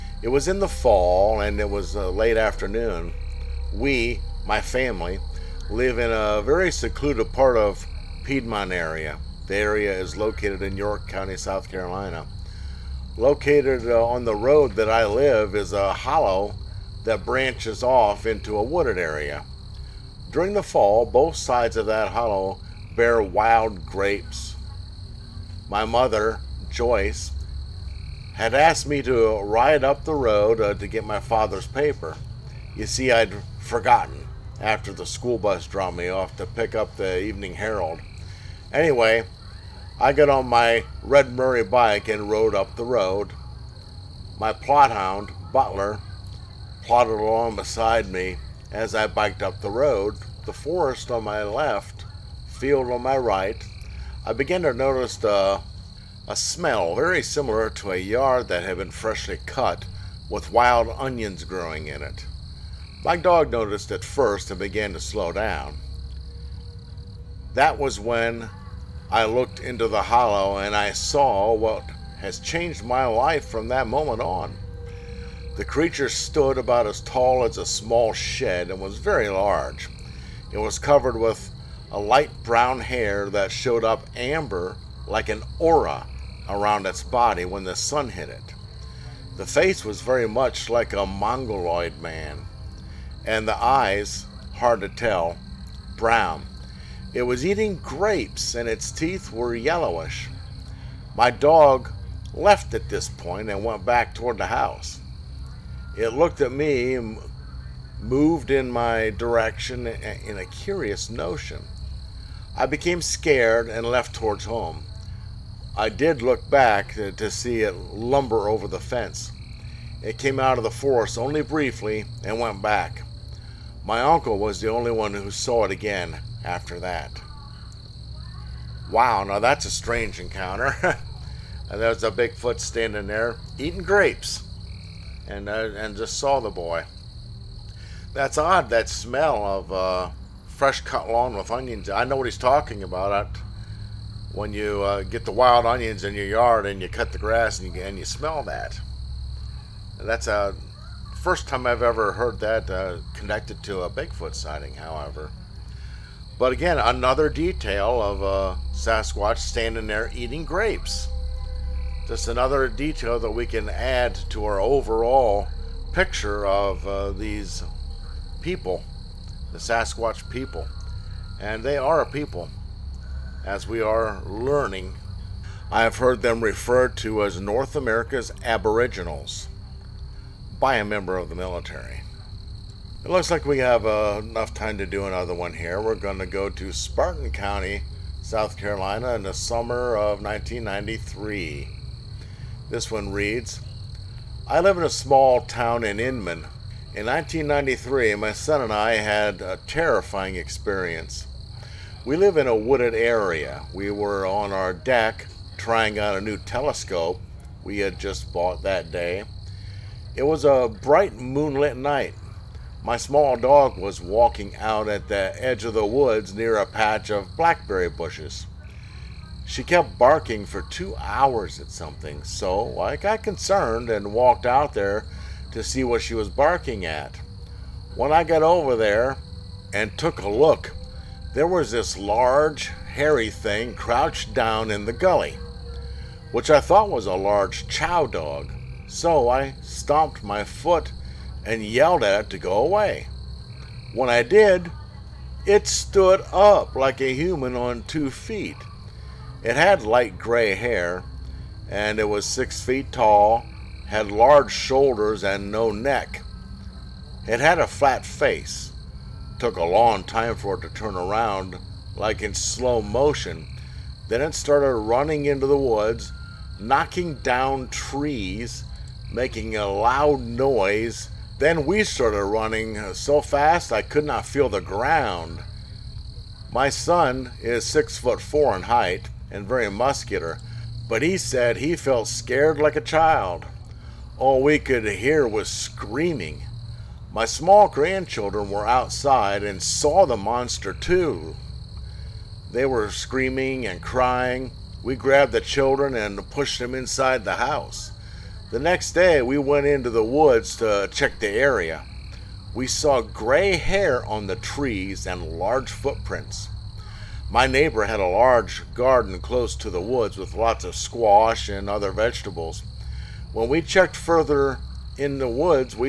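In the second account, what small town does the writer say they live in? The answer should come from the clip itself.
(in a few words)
Inman.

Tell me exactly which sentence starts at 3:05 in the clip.
We're going to go to Spartan County, South Carolina in the summer of 1993.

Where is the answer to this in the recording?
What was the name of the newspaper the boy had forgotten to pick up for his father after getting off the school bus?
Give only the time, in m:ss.
0:37.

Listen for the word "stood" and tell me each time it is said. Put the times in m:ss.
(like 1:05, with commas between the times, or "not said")
1:16, 4:05.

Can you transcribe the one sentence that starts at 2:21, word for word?
I know what he's talking about.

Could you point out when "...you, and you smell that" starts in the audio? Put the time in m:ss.
2:27.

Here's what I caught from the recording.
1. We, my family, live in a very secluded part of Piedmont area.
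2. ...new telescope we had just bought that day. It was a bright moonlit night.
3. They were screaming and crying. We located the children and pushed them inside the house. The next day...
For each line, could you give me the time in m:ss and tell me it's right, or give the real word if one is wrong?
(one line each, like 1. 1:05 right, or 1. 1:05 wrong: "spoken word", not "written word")
1. 0:03 right
2. 3:26 right
3. 4:52 wrong: "grabbed", not "located".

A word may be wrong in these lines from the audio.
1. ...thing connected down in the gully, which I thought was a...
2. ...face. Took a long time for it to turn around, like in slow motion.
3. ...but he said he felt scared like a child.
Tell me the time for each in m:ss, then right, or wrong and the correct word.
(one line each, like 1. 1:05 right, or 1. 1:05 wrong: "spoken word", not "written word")
1. 3:53 wrong: "crouched", not "connected"
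2. 4:18 right
3. 4:40 right.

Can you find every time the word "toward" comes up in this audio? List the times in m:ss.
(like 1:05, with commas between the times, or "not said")
1:44, 1:54.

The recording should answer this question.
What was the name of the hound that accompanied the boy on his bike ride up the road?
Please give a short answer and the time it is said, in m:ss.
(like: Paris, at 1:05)
Butler, at 0:45.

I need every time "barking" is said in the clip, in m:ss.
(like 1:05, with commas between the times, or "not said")
3:39, 3:46.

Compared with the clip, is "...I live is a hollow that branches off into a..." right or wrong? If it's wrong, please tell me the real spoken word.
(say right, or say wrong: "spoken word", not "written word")
right.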